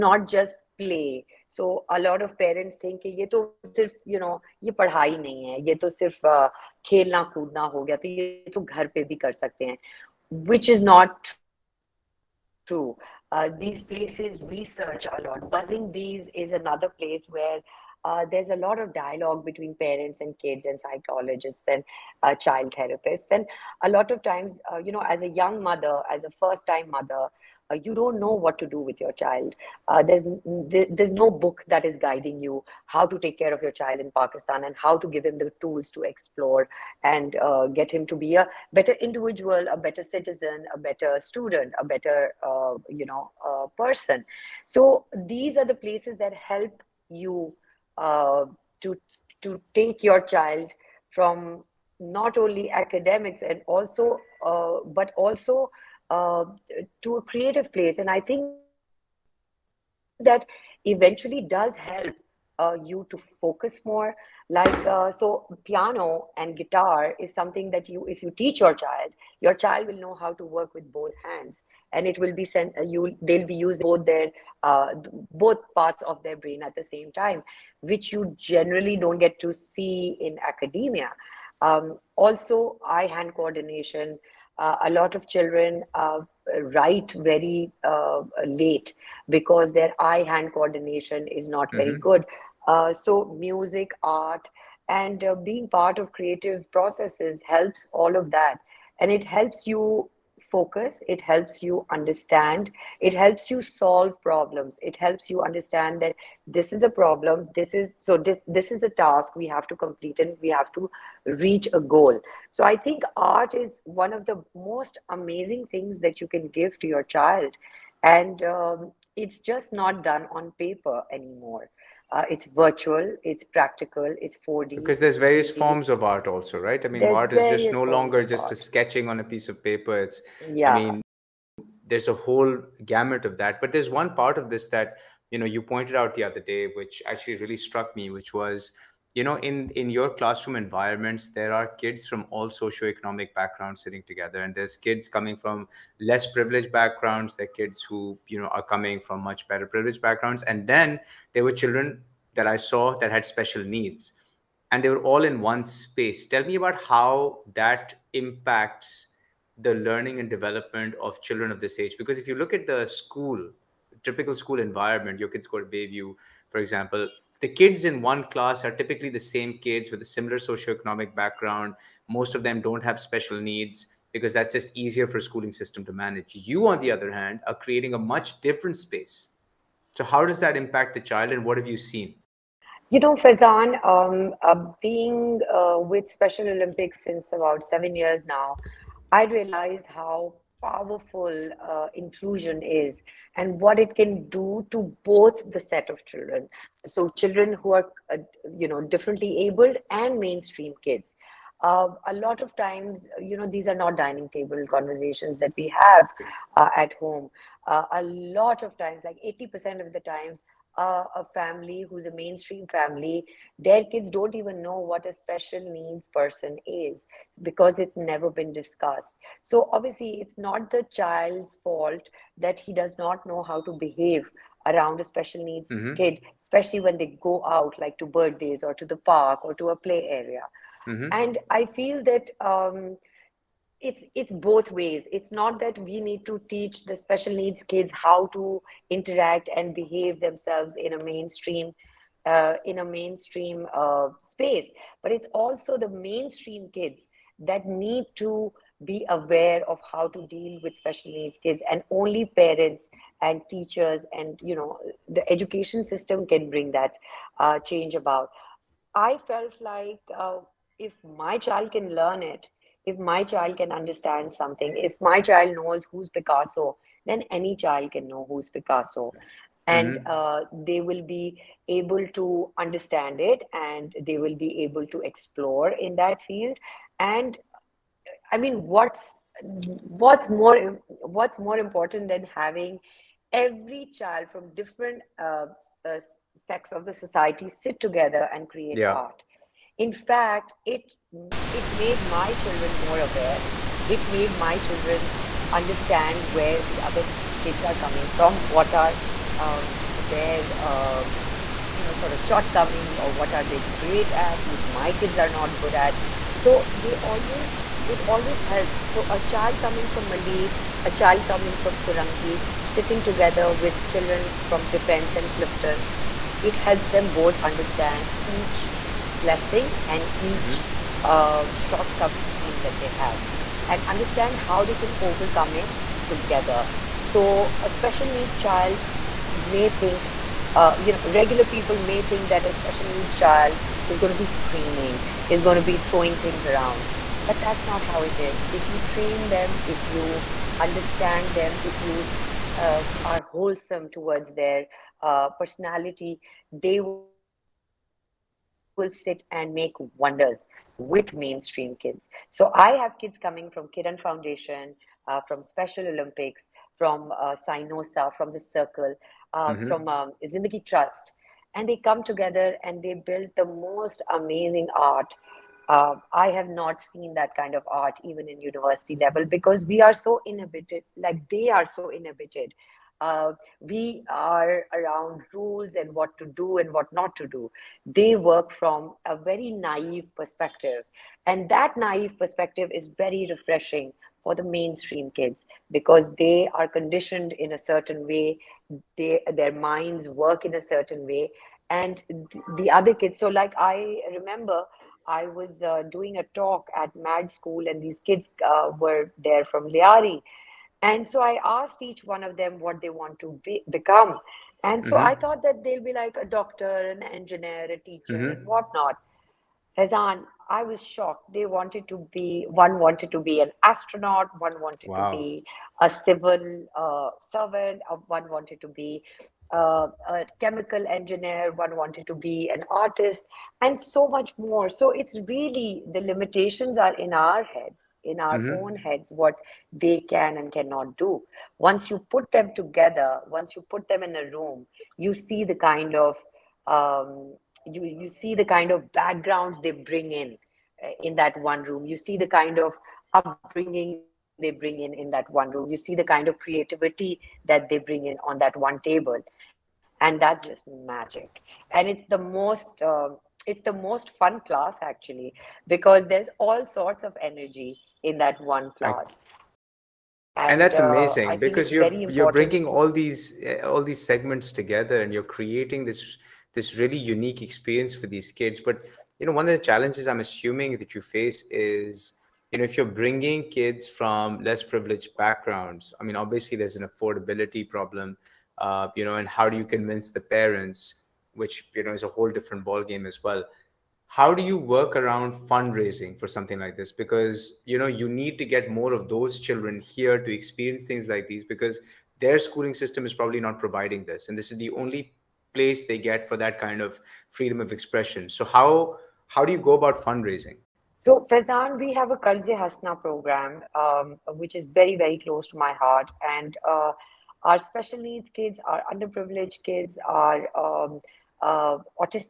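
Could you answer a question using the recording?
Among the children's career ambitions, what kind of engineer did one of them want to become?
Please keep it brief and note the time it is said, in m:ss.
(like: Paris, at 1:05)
Chemical engineer, at 7:00.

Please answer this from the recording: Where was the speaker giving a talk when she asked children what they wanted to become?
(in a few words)
Mad School.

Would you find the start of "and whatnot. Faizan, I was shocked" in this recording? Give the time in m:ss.
6:48.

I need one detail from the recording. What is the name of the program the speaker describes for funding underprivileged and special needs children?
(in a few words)
Karze Hasna.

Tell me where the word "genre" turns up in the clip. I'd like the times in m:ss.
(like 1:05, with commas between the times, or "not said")
not said.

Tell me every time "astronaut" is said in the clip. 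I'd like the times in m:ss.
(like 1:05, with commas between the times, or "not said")
6:53.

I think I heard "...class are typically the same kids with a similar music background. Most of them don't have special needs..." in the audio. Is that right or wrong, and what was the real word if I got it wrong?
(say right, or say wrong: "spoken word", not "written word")
wrong: "socioeconomic", not "music".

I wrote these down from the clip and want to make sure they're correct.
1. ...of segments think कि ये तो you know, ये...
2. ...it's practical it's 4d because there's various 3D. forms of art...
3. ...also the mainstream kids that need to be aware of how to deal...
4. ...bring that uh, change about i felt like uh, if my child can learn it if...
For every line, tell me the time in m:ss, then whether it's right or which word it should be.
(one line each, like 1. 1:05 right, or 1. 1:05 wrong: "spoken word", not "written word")
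1. 0:02 wrong: "parents", not "segments"
2. 2:03 right
3. 4:05 right
4. 4:16 right.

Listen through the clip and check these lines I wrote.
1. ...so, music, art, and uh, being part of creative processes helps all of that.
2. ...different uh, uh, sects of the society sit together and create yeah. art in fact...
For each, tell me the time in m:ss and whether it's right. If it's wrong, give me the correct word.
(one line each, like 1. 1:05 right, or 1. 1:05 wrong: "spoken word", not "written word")
1. 1:32 right
2. 4:44 right.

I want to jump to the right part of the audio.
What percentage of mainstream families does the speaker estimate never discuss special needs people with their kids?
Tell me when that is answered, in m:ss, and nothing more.
3:29.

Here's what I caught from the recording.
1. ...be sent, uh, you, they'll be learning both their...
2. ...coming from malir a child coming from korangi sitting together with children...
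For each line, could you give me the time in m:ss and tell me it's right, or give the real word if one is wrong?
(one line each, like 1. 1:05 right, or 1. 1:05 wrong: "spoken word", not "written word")
1. 1:12 wrong: "using", not "learning"
2. 5:09 right.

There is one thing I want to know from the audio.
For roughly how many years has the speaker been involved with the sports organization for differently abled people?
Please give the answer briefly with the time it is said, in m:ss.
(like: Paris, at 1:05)
7, at 3:07.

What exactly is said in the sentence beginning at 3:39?
So, obviously, it's not the child's fault that he does not know how to behave around a special needs mm-hmm.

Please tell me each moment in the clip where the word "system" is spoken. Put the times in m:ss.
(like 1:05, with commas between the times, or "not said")
2:55, 4:15, 8:12.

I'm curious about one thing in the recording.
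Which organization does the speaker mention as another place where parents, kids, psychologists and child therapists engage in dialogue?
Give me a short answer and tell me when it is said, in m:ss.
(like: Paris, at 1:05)
Buzzing Bees, at 0:15.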